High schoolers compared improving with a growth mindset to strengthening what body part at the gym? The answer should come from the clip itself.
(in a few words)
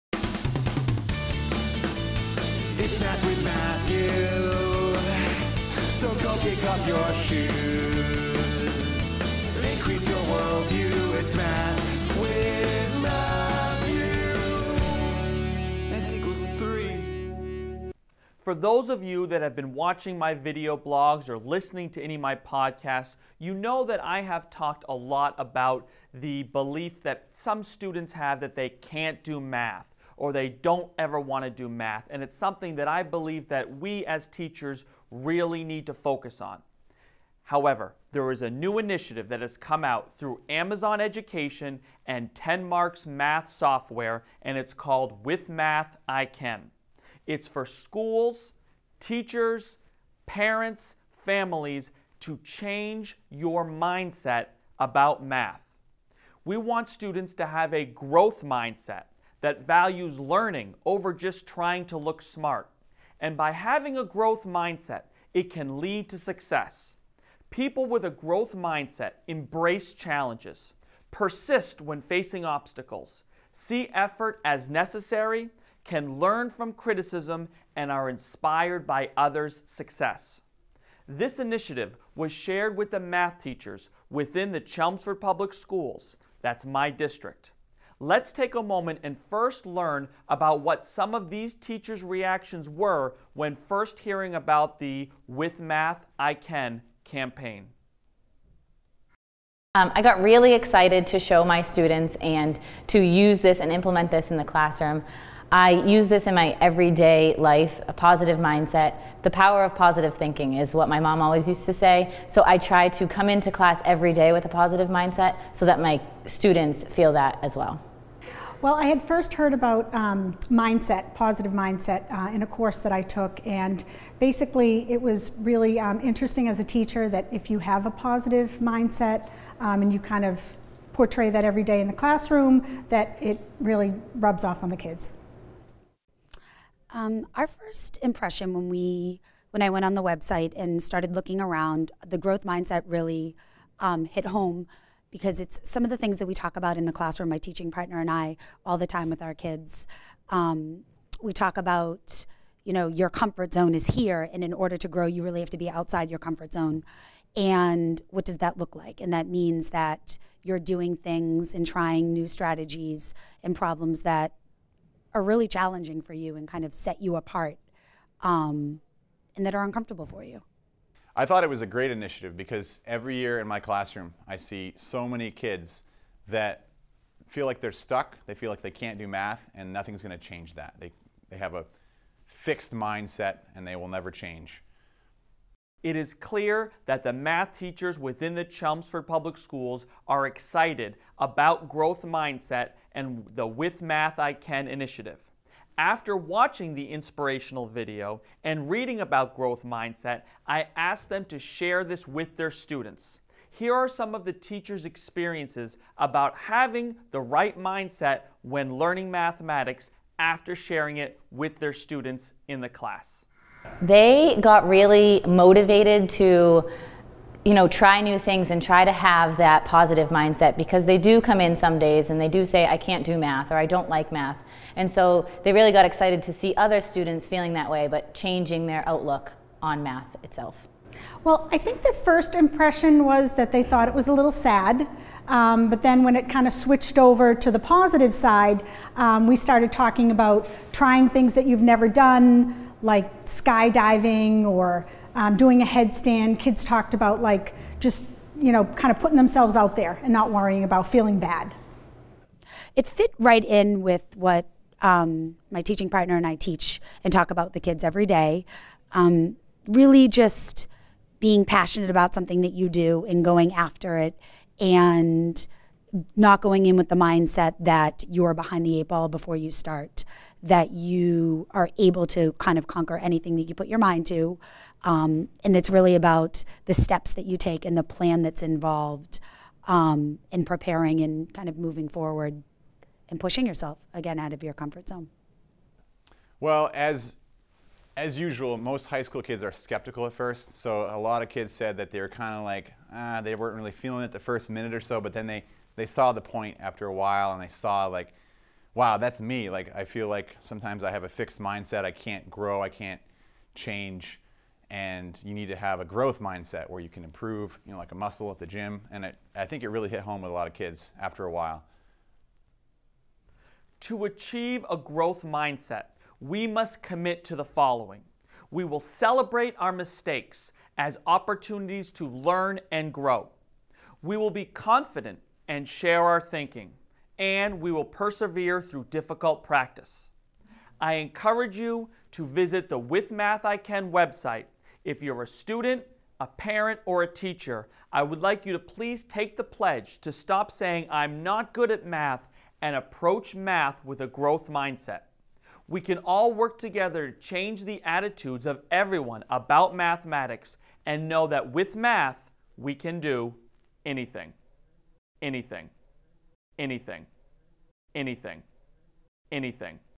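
a muscle.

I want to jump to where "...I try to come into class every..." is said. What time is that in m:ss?
1:52.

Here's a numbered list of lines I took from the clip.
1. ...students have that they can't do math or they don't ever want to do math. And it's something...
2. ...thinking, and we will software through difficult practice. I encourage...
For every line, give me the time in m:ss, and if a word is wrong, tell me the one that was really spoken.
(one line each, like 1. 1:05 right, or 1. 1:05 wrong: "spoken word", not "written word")
1. 0:27 right
2. 5:26 wrong: "persevere", not "software".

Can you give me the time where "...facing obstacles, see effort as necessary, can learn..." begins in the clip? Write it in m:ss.
1:12.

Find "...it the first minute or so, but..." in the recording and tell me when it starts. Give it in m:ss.
4:54.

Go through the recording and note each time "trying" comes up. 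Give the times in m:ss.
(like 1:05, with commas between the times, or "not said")
1:01, 2:41, 4:00.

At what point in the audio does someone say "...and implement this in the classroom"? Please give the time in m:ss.
1:43.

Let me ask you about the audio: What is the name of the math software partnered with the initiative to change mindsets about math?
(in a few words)
TenMarks.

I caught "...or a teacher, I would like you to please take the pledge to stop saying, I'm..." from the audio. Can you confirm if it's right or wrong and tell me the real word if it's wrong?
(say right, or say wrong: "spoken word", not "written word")
right.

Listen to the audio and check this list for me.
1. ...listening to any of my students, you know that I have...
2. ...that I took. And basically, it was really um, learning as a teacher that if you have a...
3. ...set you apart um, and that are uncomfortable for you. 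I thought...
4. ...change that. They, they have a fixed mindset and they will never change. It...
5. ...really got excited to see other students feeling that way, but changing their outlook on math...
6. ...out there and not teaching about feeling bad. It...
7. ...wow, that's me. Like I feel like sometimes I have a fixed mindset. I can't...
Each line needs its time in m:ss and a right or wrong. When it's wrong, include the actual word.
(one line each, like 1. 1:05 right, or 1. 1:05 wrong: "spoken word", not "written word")
1. 0:21 wrong: "podcasts", not "students"
2. 2:02 wrong: "interesting", not "learning"
3. 2:46 right
4. 3:00 right
5. 3:45 right
6. 4:09 wrong: "worrying", not "teaching"
7. 4:58 right.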